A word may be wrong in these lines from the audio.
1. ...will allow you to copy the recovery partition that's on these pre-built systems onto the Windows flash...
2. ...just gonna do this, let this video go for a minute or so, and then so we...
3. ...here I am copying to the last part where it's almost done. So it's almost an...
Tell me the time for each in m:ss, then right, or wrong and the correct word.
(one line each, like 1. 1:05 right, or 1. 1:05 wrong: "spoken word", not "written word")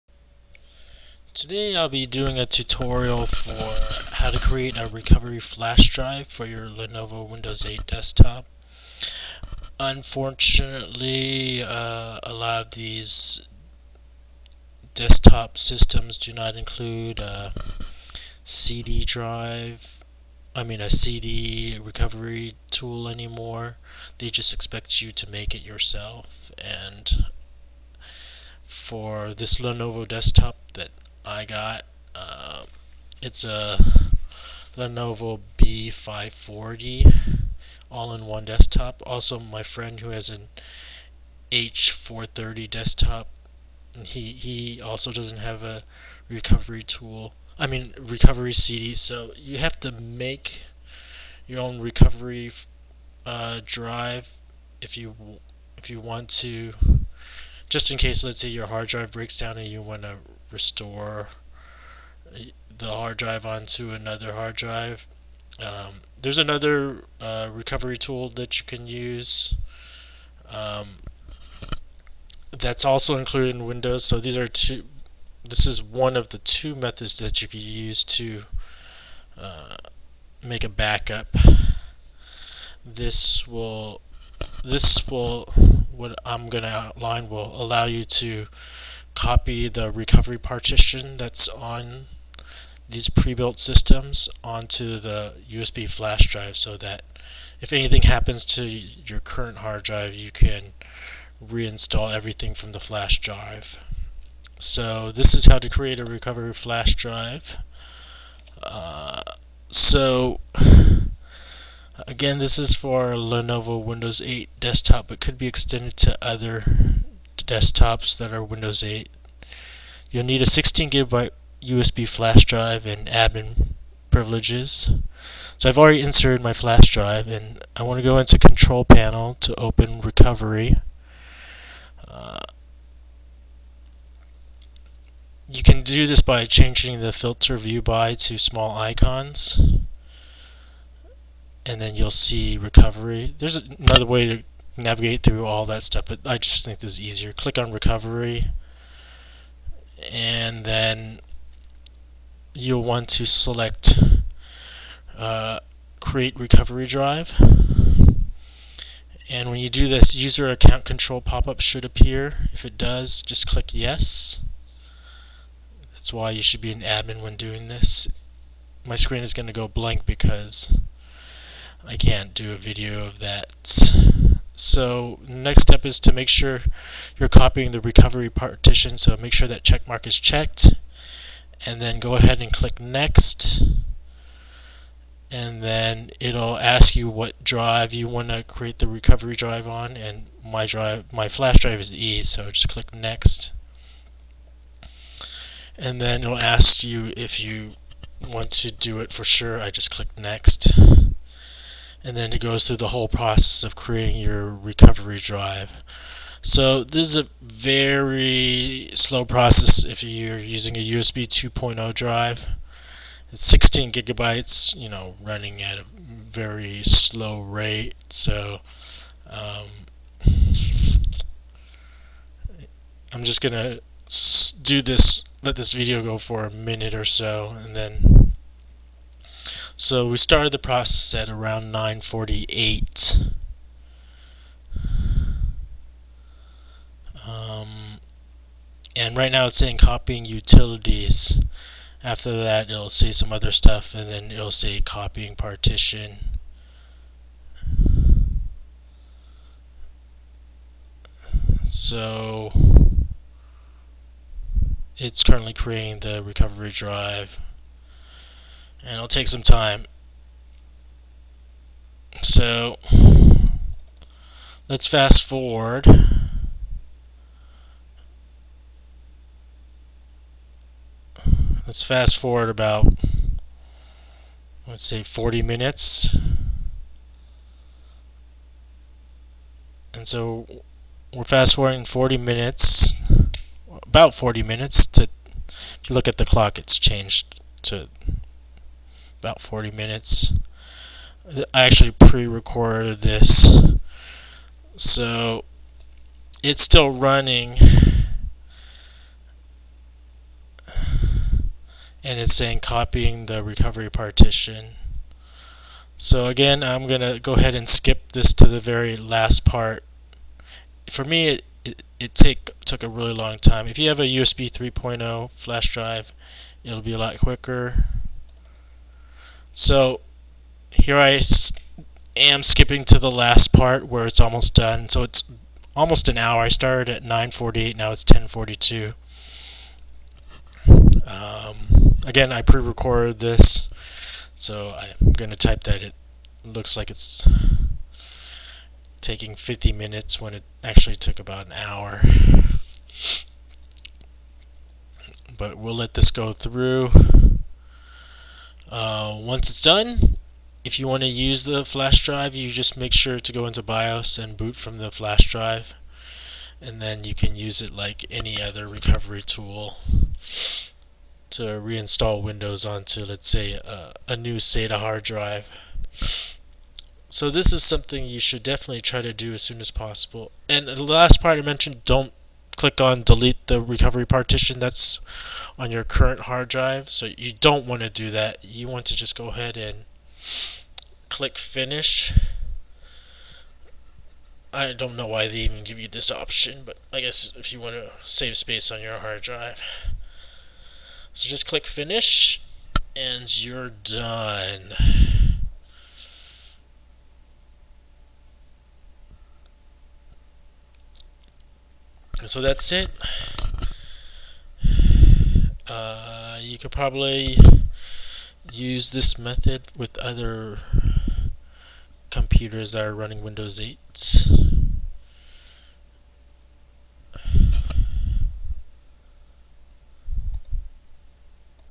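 1. 1:27 wrong: "USB", not "Windows"
2. 3:43 right
3. 5:20 wrong: "skipping", not "copying".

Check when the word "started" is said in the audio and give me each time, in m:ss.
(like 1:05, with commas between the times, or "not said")
3:50, 5:26.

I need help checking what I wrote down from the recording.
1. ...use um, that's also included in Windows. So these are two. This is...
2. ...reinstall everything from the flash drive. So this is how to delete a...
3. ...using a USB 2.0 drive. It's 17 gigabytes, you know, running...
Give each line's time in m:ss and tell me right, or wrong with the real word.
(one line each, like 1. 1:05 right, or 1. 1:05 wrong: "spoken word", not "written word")
1. 1:08 right
2. 1:41 wrong: "create", not "delete"
3. 3:30 wrong: "16", not "17".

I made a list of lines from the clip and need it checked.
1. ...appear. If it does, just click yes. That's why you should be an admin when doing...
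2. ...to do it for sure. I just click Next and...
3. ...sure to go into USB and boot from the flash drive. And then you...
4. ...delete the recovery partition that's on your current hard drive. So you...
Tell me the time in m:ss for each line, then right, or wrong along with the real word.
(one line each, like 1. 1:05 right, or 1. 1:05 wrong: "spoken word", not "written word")
1. 2:41 right
2. 3:18 right
3. 5:52 wrong: "BIOS", not "USB"
4. 6:13 right.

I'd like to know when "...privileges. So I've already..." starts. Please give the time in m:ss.
2:04.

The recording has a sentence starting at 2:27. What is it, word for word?
Click on recovery, and then you'll want to select uh, create recovery drive.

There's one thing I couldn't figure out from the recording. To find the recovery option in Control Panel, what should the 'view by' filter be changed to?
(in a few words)
Small icons.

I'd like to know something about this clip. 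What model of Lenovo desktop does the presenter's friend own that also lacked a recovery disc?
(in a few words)
H430.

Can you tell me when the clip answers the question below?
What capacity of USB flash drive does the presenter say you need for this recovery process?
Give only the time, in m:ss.
2:00.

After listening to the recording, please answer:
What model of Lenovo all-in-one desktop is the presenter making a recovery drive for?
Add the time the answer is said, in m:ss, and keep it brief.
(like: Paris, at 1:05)
B540, at 0:34.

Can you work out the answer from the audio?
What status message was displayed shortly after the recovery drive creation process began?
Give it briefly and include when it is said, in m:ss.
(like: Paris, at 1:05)
Copying utilities, at 3:59.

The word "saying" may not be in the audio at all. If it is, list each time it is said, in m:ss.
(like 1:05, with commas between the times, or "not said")
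3:59, 5:02.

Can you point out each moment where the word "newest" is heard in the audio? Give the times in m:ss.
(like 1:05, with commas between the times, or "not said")
not said.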